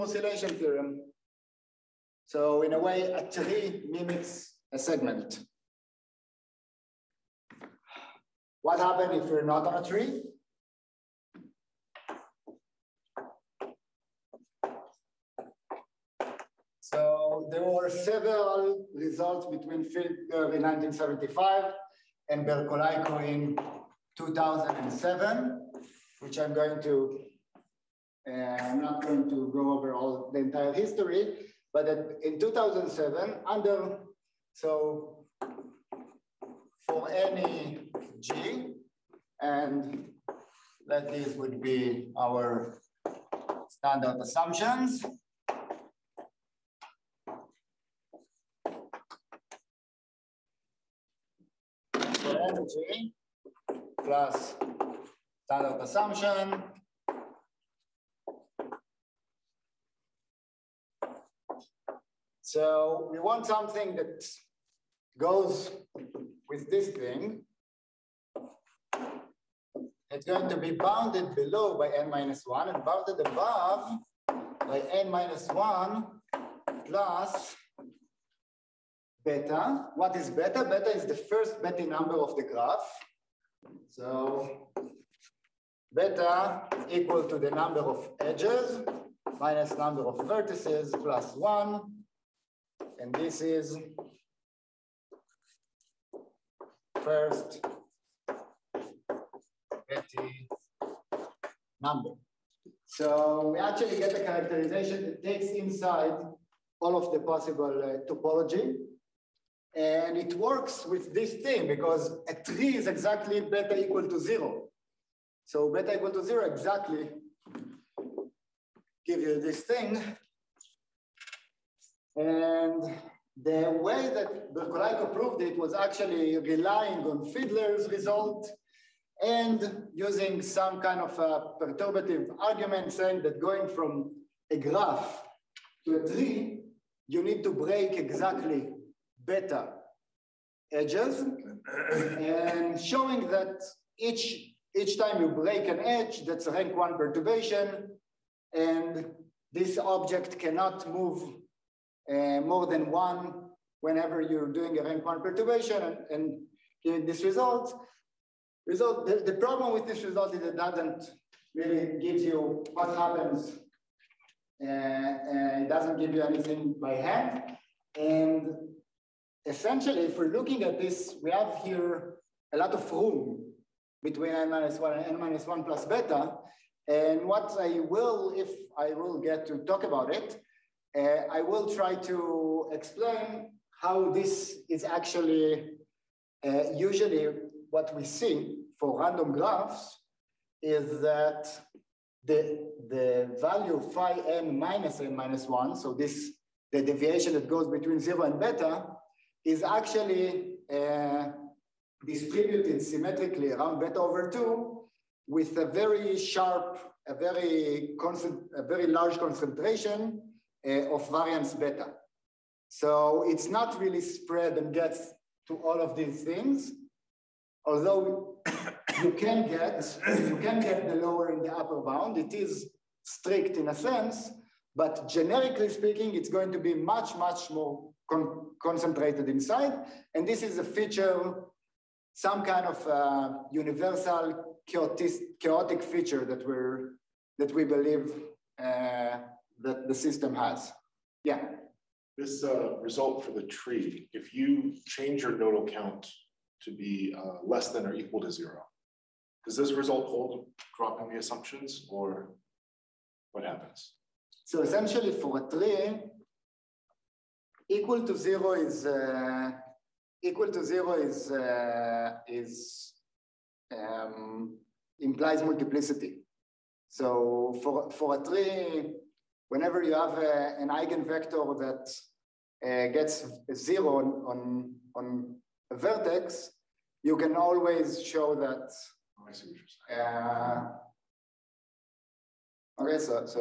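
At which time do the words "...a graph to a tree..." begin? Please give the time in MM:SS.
02:14.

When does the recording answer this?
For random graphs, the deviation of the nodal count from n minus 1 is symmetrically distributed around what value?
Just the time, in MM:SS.
03:23.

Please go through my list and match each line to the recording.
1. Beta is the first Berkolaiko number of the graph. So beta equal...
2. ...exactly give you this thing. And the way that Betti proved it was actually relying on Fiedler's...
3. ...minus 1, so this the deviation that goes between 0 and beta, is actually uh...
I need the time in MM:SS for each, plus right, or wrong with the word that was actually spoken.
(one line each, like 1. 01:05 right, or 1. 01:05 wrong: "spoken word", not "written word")
1. 01:20 wrong: "Betti", not "Berkolaiko"
2. 01:56 wrong: "Berkolaiko", not "Betti"
3. 03:15 right.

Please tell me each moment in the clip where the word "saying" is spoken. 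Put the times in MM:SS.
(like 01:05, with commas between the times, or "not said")
02:12.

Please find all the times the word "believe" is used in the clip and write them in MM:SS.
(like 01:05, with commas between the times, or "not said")
03:57.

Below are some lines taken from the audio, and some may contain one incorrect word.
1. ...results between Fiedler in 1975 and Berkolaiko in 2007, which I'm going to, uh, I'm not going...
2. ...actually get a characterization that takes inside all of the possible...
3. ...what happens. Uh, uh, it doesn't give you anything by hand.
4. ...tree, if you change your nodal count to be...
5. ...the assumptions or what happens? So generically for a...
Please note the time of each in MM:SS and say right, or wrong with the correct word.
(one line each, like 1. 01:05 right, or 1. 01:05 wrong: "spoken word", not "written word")
1. 00:18 right
2. 01:43 right
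3. 02:42 right
4. 04:03 right
5. 04:11 wrong: "essentially", not "generically".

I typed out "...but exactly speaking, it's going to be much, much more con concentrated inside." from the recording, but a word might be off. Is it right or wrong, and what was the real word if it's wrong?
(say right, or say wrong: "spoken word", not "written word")
wrong: "generically", not "exactly".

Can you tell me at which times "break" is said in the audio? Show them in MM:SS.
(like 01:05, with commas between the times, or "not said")
02:17, 02:25.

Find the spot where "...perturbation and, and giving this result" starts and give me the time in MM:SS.
02:35.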